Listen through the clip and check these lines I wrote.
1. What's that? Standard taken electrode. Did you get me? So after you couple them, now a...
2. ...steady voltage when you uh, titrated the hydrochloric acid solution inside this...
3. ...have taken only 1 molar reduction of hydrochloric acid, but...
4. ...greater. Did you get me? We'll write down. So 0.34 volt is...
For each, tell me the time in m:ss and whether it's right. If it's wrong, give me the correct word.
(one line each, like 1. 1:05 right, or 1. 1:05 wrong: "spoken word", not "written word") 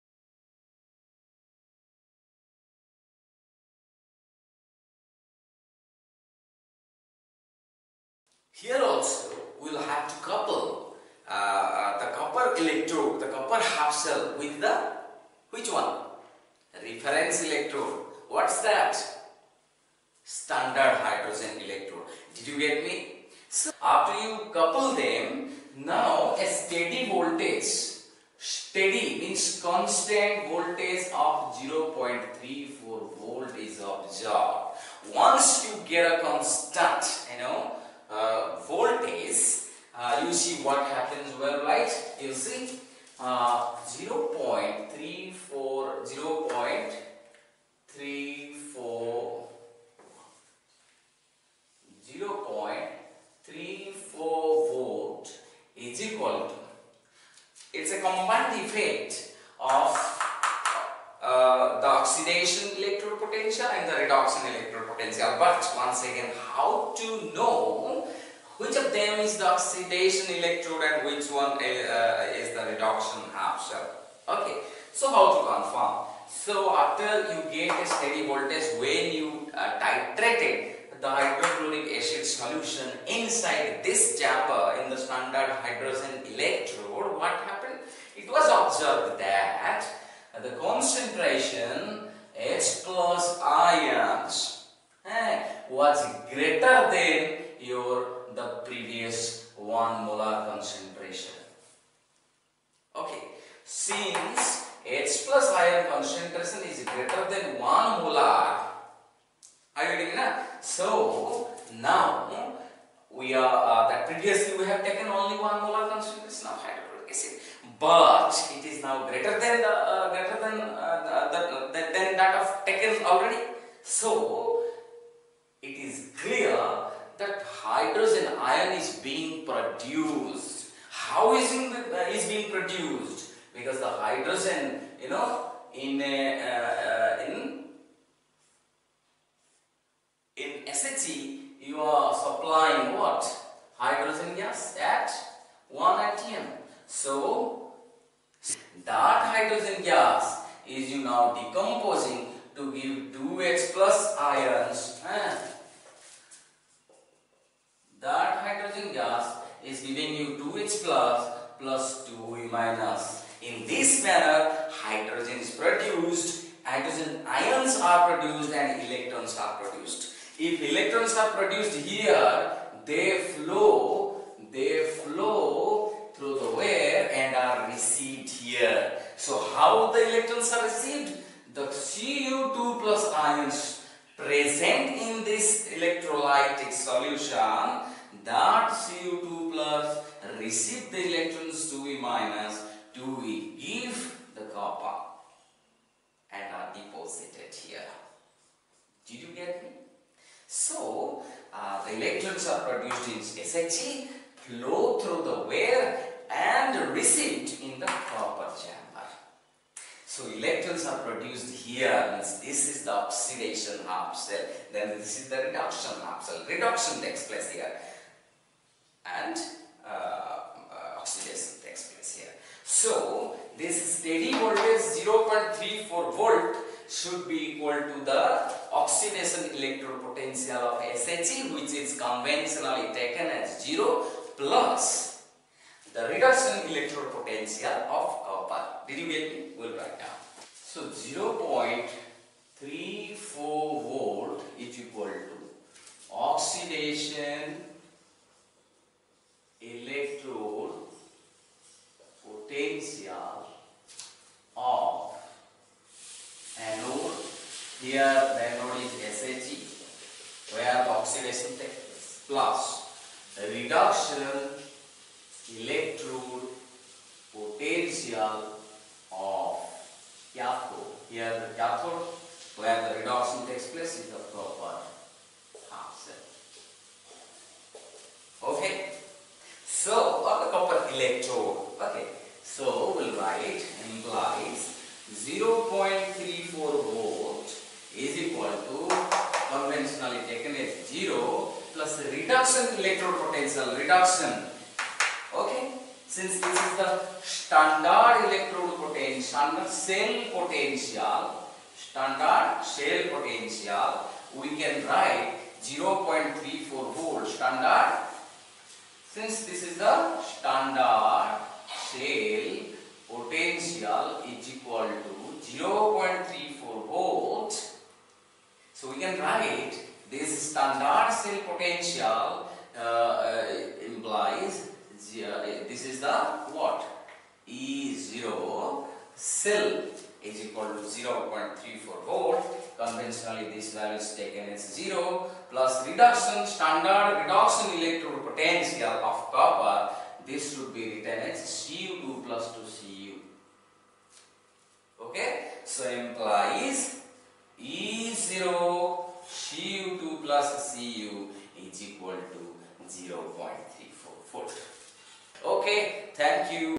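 1. 0:18 wrong: "hydrogen", not "taken"
2. 1:17 right
3. 1:54 wrong: "concentration", not "reduction"
4. 3:58 wrong: "copper", not "greater".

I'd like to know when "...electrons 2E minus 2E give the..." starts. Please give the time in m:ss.
3:11.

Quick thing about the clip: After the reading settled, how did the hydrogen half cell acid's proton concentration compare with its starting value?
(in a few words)
Greater than 1 molar.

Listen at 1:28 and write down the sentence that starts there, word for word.
It was observed that the concentration H plus ions eh, was greater than your the previous 1 molar concentration.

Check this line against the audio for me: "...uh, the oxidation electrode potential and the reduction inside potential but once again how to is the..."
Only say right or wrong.
wrong.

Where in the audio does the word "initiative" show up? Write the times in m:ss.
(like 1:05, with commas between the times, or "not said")
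not said.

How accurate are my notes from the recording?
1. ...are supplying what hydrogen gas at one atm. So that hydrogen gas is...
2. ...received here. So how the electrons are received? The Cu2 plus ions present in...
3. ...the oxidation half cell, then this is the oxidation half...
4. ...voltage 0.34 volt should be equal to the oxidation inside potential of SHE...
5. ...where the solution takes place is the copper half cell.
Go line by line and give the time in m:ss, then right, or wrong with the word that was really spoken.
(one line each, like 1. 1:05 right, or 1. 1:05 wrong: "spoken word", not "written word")
1. 2:21 right
2. 2:57 right
3. 3:32 wrong: "reduction", not "oxidation"
4. 3:44 wrong: "electrode", not "inside"
5. 4:32 wrong: "reduction", not "solution".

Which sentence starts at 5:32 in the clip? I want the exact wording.
Conventionally this value is taken as 0 plus reduction standard reduction electrode potential of copper.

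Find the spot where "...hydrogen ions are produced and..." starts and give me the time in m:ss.
2:46.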